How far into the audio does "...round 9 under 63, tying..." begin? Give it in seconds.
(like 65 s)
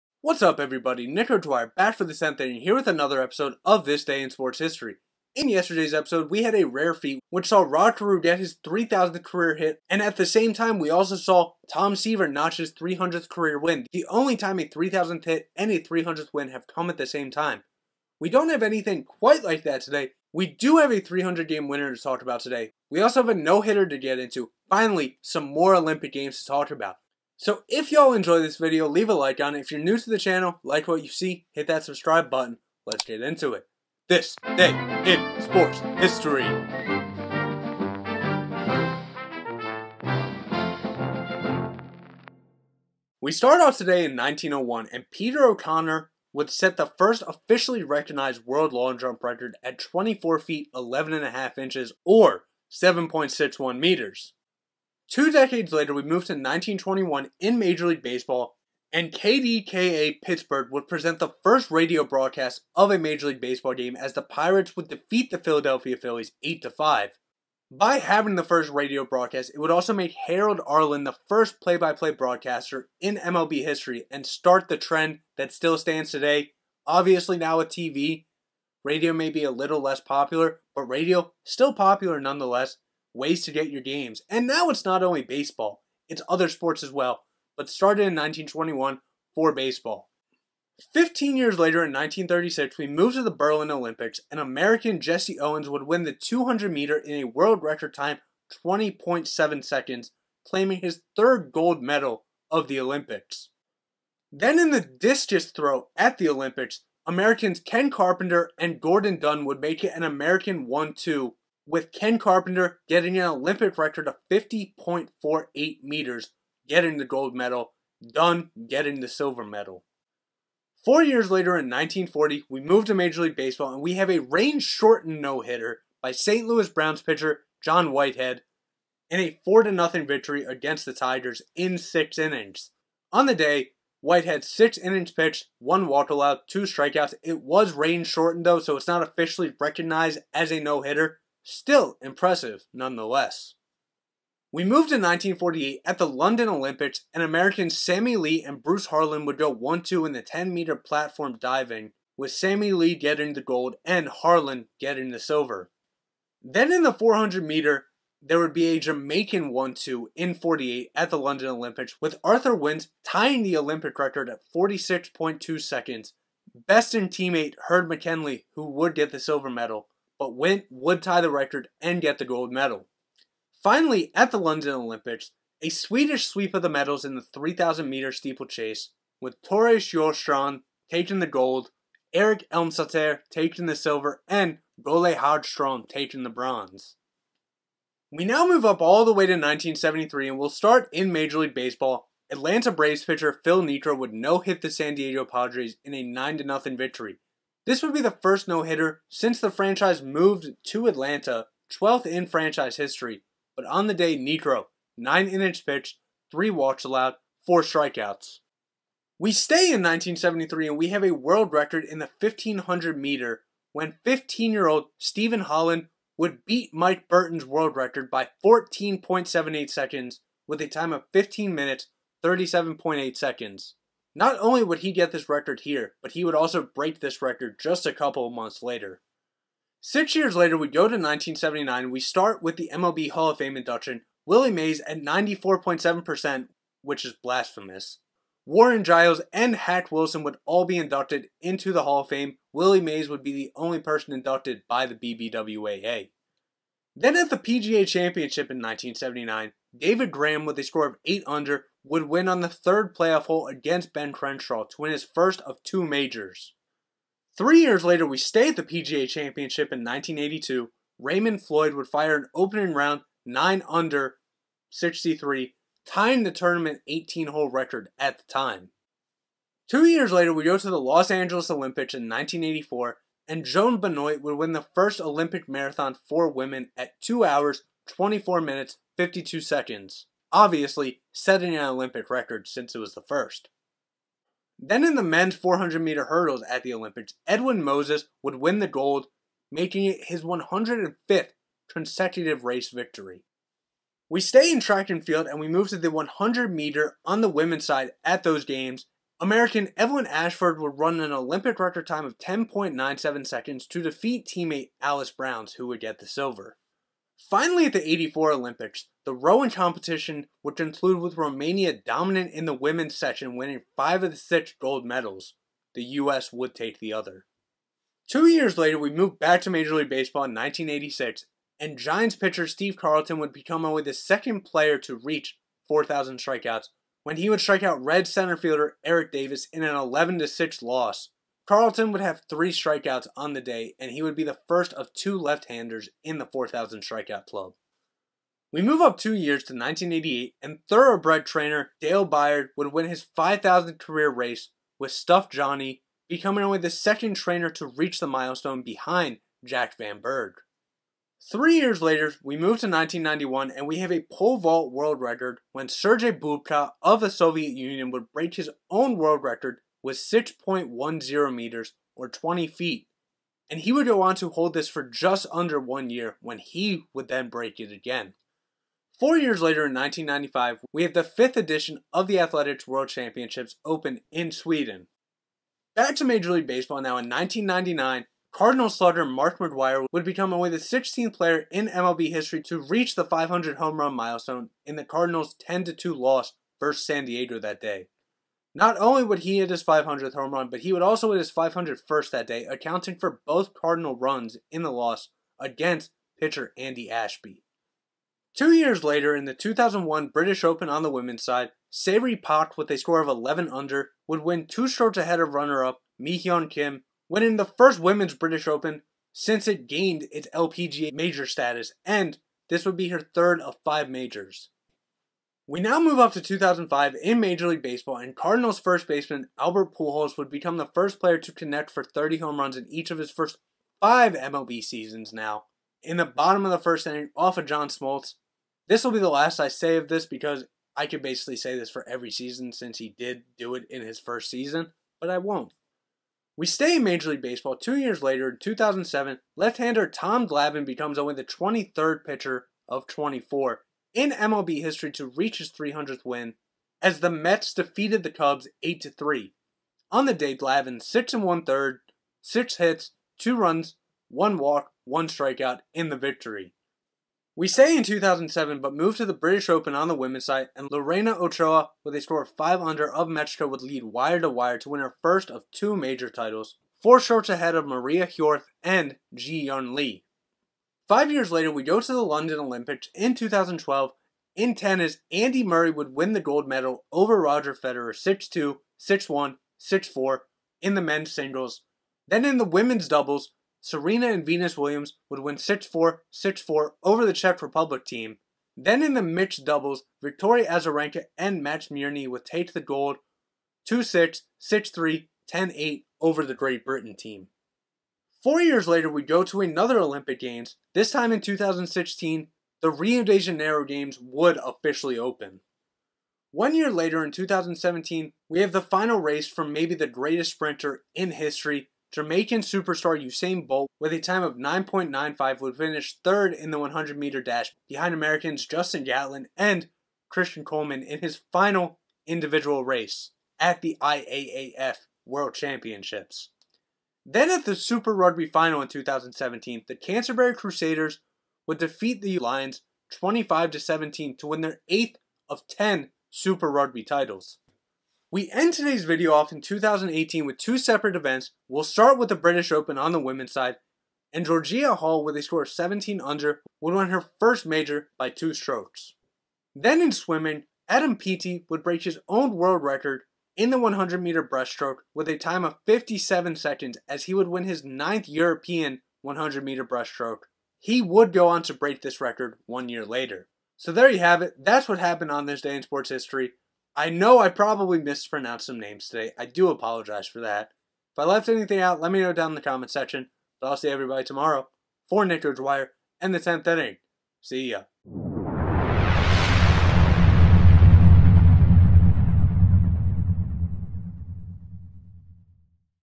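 262 s.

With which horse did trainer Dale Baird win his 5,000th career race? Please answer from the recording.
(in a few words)
Stuffed Johnny.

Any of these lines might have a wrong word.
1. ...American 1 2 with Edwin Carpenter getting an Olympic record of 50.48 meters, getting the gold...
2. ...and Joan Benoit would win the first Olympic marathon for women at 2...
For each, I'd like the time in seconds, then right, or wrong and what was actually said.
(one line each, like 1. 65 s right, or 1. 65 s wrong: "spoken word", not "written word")
1. 110 s wrong: "Ken", not "Edwin"
2. 273 s right.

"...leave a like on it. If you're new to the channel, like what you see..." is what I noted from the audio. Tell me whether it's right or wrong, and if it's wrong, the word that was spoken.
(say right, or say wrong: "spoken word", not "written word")
right.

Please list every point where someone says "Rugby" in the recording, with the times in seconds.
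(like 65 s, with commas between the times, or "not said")
527 s, 536 s.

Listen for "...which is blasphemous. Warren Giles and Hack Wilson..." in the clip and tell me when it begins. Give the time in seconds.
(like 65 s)
236 s.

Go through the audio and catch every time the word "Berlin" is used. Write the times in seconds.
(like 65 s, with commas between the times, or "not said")
93 s.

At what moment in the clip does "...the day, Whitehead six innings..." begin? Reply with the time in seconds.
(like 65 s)
133 s.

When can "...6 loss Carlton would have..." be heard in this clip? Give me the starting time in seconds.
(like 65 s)
330 s.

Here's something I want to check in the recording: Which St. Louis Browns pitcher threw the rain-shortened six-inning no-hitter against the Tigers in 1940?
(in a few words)
John Whitehead.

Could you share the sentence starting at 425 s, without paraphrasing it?
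In the bottom of the first inning, off of John Smoltz.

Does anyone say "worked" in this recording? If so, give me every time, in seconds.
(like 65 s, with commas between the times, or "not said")
not said.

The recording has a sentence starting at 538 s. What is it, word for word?
We end today's video off in 2018 with two separate events.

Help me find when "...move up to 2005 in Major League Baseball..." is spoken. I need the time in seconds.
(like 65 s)
415 s.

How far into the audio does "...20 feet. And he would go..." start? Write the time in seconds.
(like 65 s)
362 s.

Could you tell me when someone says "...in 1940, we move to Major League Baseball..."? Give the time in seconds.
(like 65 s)
121 s.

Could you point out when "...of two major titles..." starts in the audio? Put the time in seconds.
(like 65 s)
465 s.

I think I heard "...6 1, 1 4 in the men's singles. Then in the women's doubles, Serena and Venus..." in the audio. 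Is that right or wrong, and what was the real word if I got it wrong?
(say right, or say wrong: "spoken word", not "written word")
wrong: "6", not "1".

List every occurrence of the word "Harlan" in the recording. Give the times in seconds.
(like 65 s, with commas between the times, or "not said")
148 s, 154 s.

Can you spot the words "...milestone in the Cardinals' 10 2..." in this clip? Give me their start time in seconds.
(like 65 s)
383 s.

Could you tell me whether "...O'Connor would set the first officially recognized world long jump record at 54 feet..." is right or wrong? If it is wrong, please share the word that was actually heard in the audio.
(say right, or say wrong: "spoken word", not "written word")
wrong: "24", not "54".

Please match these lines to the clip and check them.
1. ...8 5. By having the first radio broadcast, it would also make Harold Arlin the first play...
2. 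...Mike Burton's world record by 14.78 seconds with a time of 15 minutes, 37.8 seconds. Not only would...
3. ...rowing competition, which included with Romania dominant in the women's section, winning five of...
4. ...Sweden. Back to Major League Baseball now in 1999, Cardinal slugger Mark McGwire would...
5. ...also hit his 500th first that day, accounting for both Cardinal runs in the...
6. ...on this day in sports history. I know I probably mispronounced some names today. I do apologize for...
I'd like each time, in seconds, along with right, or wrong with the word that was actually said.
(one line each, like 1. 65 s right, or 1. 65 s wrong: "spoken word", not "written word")
1. 66 s right
2. 216 s right
3. 309 s right
4. 374 s right
5. 390 s right
6. 565 s right.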